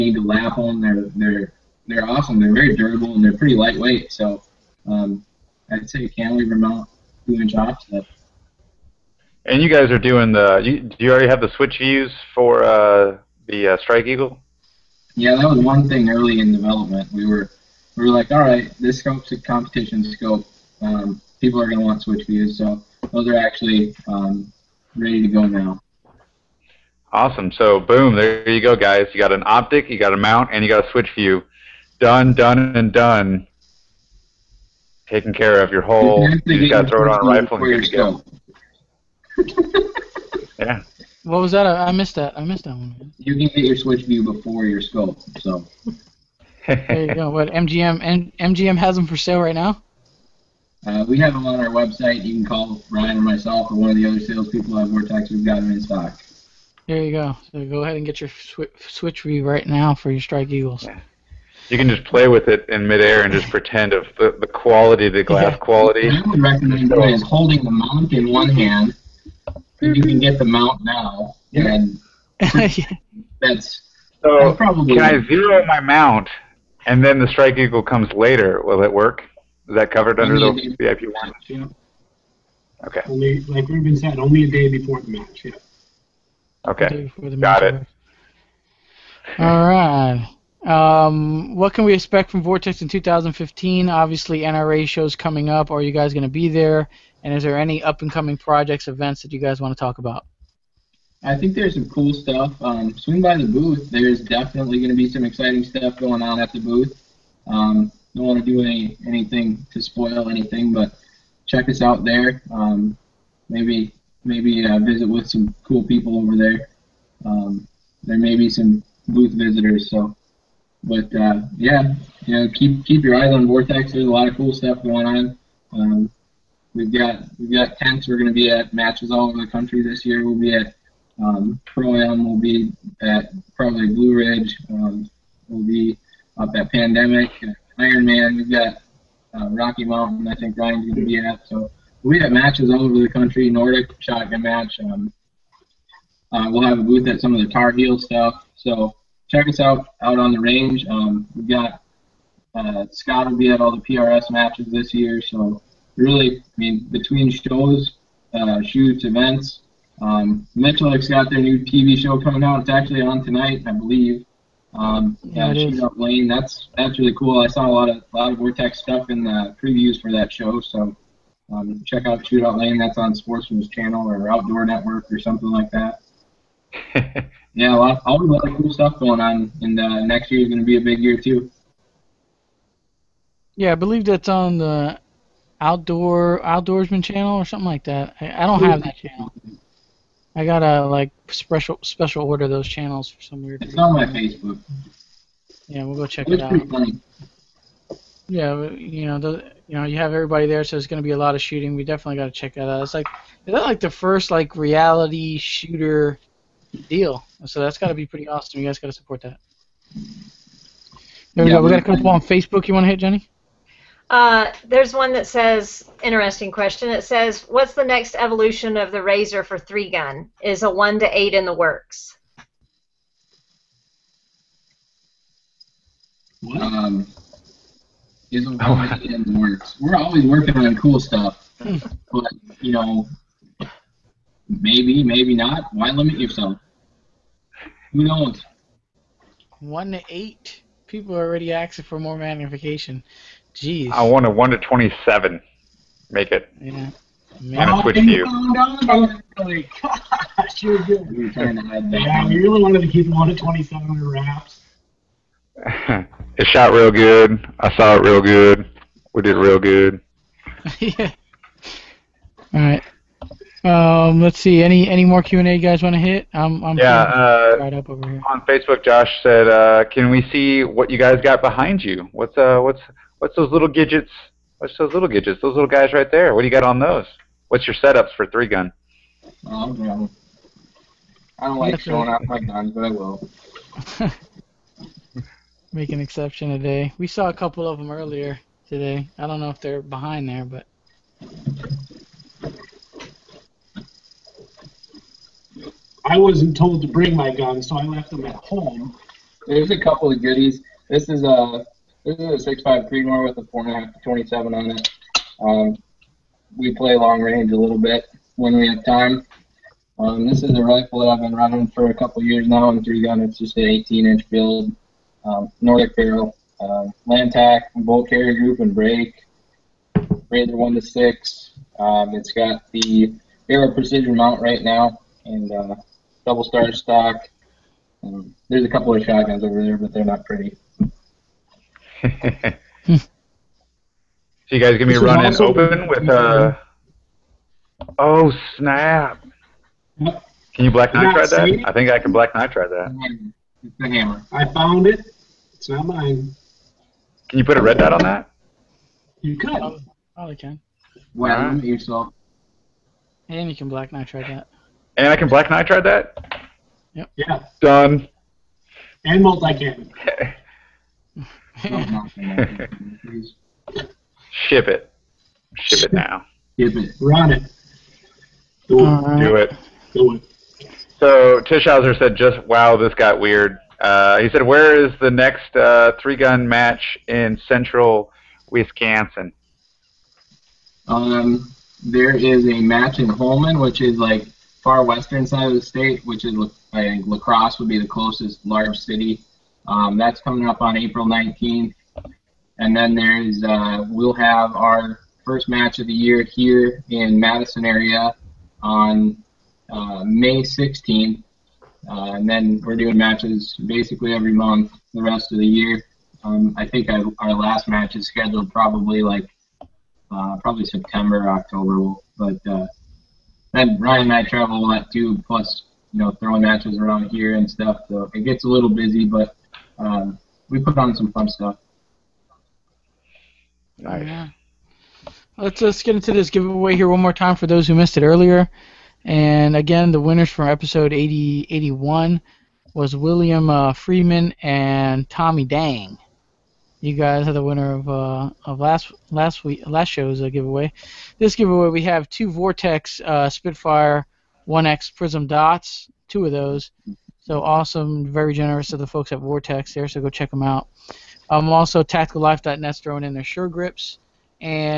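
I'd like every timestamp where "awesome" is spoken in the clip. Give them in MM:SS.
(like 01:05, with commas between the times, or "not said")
00:02, 00:27, 03:28, 07:27.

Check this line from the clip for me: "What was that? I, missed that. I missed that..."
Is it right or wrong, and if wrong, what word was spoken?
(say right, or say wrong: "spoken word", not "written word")
right.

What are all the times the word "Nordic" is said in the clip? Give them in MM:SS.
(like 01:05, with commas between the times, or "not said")
02:23, 05:15.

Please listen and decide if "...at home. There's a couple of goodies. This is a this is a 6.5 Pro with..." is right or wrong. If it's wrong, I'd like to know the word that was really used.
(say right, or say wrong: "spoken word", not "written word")
wrong: "Creedmoor", not "Pro".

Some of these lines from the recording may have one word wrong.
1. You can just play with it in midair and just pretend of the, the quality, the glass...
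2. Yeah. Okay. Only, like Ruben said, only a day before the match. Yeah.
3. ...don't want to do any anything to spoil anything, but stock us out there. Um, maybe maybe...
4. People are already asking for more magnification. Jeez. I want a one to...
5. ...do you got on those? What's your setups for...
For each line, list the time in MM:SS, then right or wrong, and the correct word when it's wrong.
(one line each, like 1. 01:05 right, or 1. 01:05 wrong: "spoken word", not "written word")
1. 01:01 right
2. 01:21 right
3. 01:48 wrong: "check", not "stock"
4. 04:00 right
5. 04:36 right.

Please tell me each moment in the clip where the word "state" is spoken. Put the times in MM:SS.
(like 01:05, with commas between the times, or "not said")
06:25.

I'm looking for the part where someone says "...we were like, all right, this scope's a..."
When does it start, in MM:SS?
00:17.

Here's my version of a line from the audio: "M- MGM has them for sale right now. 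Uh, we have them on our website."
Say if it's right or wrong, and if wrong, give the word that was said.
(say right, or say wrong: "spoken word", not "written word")
right.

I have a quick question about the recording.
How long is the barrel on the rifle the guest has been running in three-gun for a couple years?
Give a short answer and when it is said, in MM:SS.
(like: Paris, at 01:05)
18 inch, at 05:13.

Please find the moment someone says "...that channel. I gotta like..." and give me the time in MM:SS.
03:08.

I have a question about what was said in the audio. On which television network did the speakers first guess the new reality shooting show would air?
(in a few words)
Sportsman's Channel.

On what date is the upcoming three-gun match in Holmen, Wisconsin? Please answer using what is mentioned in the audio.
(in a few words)
April 19th.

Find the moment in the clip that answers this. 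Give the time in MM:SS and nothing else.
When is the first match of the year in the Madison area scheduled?
06:40.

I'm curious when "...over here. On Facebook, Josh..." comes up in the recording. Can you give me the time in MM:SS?
04:27.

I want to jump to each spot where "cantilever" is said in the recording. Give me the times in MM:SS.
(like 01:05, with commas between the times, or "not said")
00:06.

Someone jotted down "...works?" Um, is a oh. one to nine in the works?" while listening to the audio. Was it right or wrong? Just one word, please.
wrong.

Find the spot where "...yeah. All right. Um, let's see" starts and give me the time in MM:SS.
04:20.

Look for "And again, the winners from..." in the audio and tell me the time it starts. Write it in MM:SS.
07:09.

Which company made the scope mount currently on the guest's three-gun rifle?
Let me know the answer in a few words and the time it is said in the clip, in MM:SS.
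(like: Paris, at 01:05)
Aero Precision, at 05:23.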